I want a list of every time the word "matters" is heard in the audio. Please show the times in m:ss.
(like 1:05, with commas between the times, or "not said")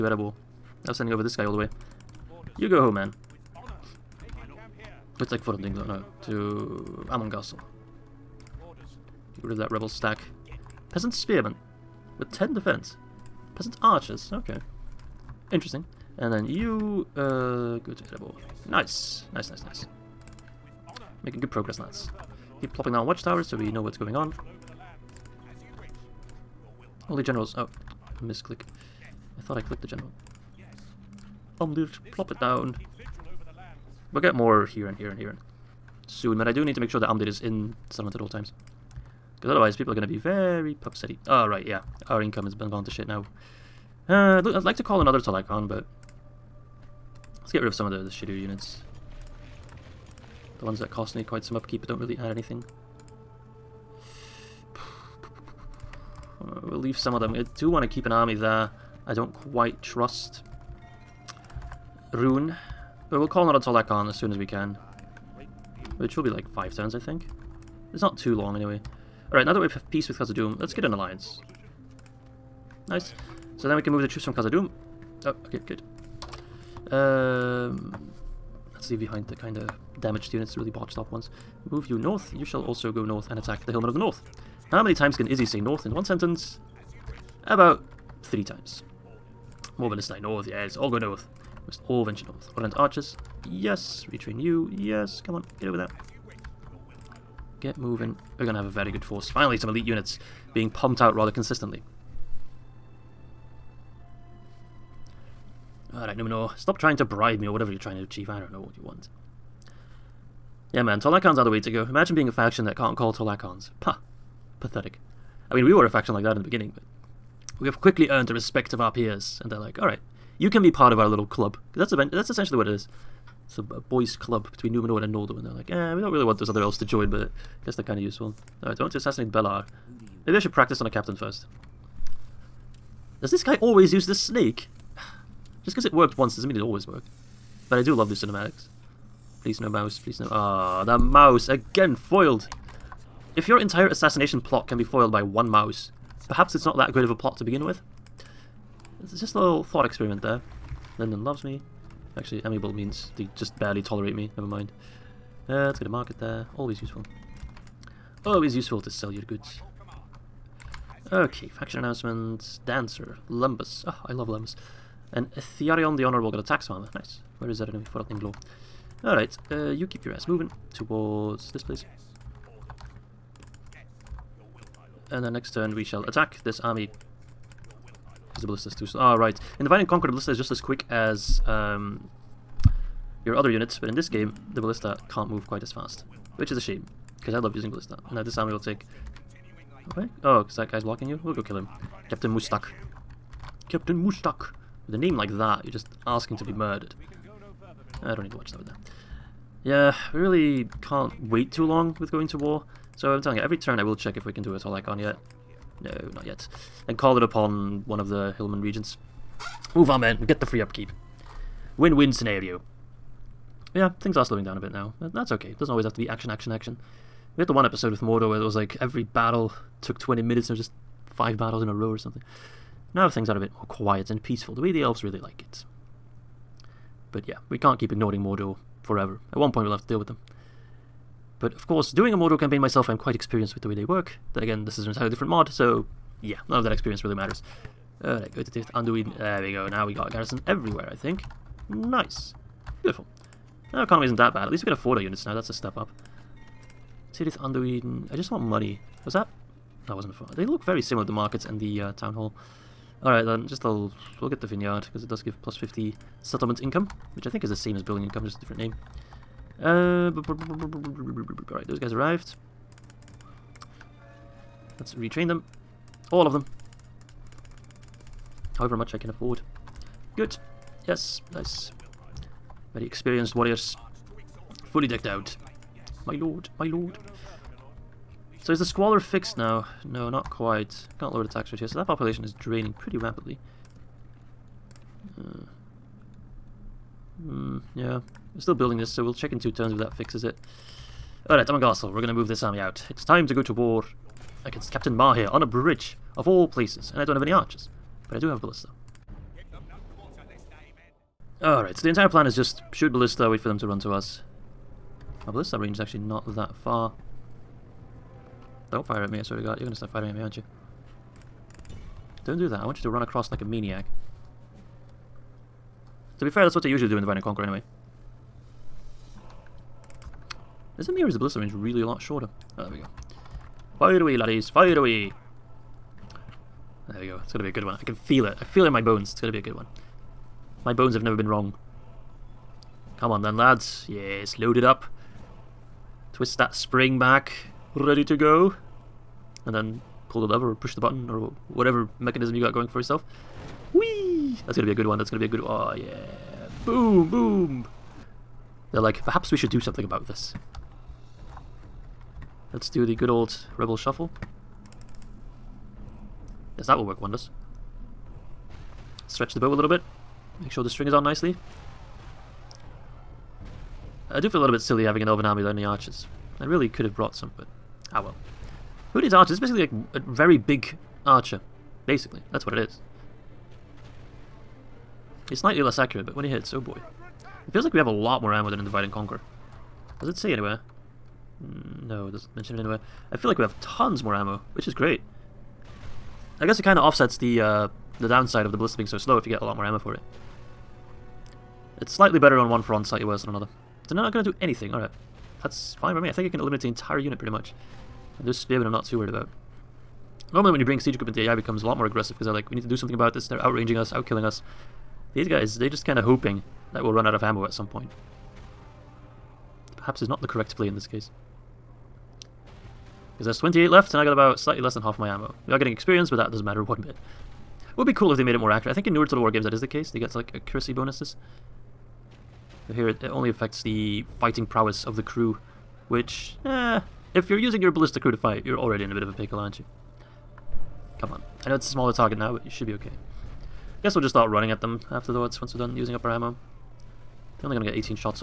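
3:57, 6:56.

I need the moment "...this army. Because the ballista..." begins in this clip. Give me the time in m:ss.
2:56.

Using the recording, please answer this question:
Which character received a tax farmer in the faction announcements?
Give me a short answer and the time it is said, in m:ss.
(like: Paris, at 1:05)
Thearion the Honorable, at 2:45.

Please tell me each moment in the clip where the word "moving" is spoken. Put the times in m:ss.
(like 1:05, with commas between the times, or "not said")
1:37, 2:50.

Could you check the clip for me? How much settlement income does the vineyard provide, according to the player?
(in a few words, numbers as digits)
+50.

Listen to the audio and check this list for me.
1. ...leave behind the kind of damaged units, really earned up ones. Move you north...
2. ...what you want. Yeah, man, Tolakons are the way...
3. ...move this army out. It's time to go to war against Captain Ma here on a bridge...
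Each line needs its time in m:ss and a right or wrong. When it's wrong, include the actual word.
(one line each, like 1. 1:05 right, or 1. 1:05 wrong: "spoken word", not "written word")
1. 1:18 wrong: "botched", not "earned"
2. 1:48 right
3. 4:52 right.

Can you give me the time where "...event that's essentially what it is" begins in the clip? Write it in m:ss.
2:01.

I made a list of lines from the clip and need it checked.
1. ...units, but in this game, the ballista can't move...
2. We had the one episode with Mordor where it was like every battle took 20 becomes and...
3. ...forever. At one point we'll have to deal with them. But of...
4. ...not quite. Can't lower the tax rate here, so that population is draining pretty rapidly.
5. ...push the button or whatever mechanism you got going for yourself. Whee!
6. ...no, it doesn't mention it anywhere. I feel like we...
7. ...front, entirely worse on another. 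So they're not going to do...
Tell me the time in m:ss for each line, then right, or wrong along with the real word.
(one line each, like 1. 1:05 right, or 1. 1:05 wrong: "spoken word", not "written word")
1. 3:03 right
2. 3:37 wrong: "minutes", not "becomes"
3. 3:48 right
4. 4:40 right
5. 5:40 right
6. 6:21 right
7. 6:32 wrong: "slightly", not "entirely".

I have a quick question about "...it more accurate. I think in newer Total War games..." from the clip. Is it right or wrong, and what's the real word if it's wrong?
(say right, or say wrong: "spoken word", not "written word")
right.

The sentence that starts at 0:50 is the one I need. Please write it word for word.
The ones that cost me quite some upkeep but don't really add anything.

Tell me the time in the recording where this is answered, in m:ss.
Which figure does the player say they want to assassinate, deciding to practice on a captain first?
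2:09.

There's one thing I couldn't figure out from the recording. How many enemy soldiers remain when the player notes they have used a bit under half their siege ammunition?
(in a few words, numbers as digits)
28.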